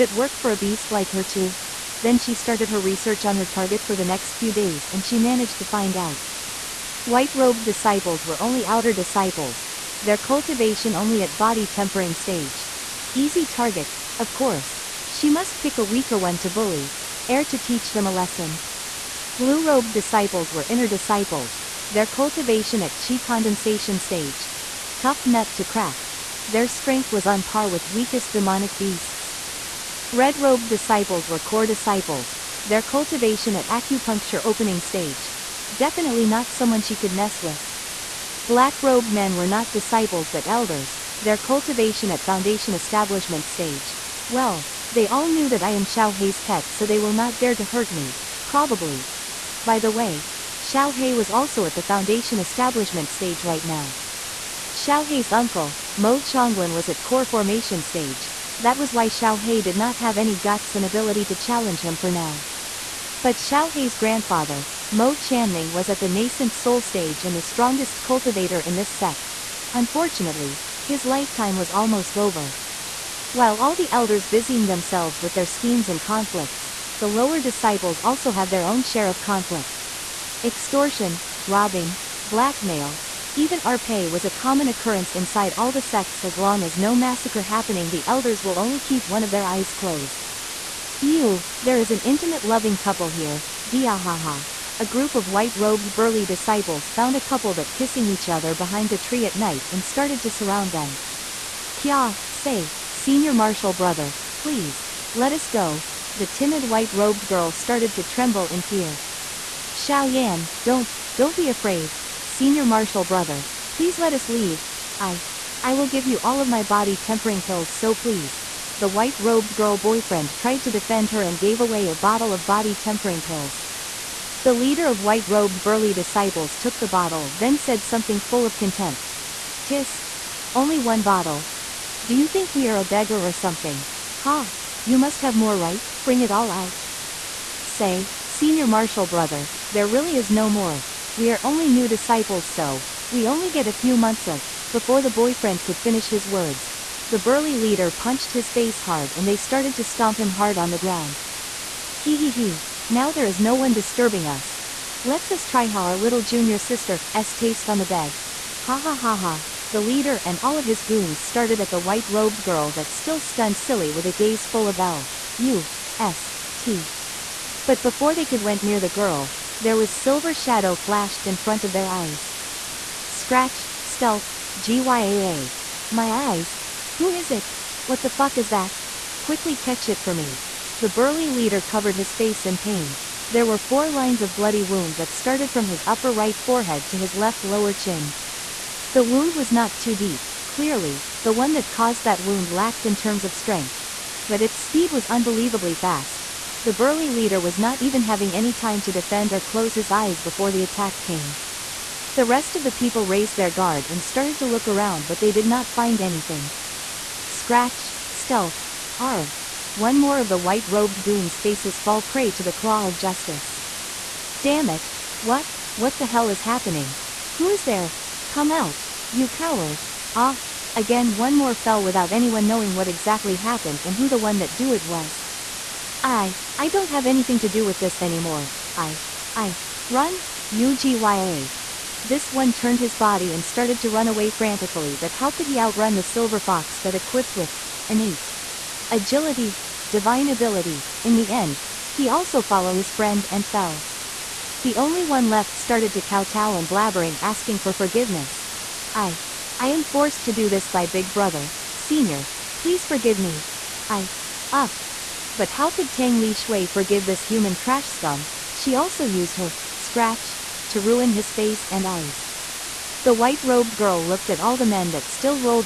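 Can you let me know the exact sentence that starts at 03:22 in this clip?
The rest of the people raised their guard and started to look around but they did not find anything.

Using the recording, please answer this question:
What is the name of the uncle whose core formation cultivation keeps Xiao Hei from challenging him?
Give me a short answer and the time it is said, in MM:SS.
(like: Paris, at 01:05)
Mo Chonglin, at 00:55.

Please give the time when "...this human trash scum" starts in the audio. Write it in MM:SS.
04:17.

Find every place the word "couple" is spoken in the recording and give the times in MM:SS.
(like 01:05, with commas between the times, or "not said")
01:32, 01:37.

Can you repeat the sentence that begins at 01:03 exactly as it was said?
But Xiao Hei's grandfather, Mo Chanming was at the nascent soul stage and the strongest cultivator in this sect.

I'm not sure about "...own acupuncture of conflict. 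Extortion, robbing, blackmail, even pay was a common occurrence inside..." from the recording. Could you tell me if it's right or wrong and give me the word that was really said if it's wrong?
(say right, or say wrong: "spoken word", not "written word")
wrong: "share", not "acupuncture".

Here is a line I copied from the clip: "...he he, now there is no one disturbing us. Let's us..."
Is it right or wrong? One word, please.
right.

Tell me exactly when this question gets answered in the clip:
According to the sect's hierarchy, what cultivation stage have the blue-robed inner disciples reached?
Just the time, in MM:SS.
00:22.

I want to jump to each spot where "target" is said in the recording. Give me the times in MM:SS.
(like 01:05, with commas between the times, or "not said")
00:03, 00:13.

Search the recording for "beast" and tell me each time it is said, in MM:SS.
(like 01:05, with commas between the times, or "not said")
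00:00, 00:28.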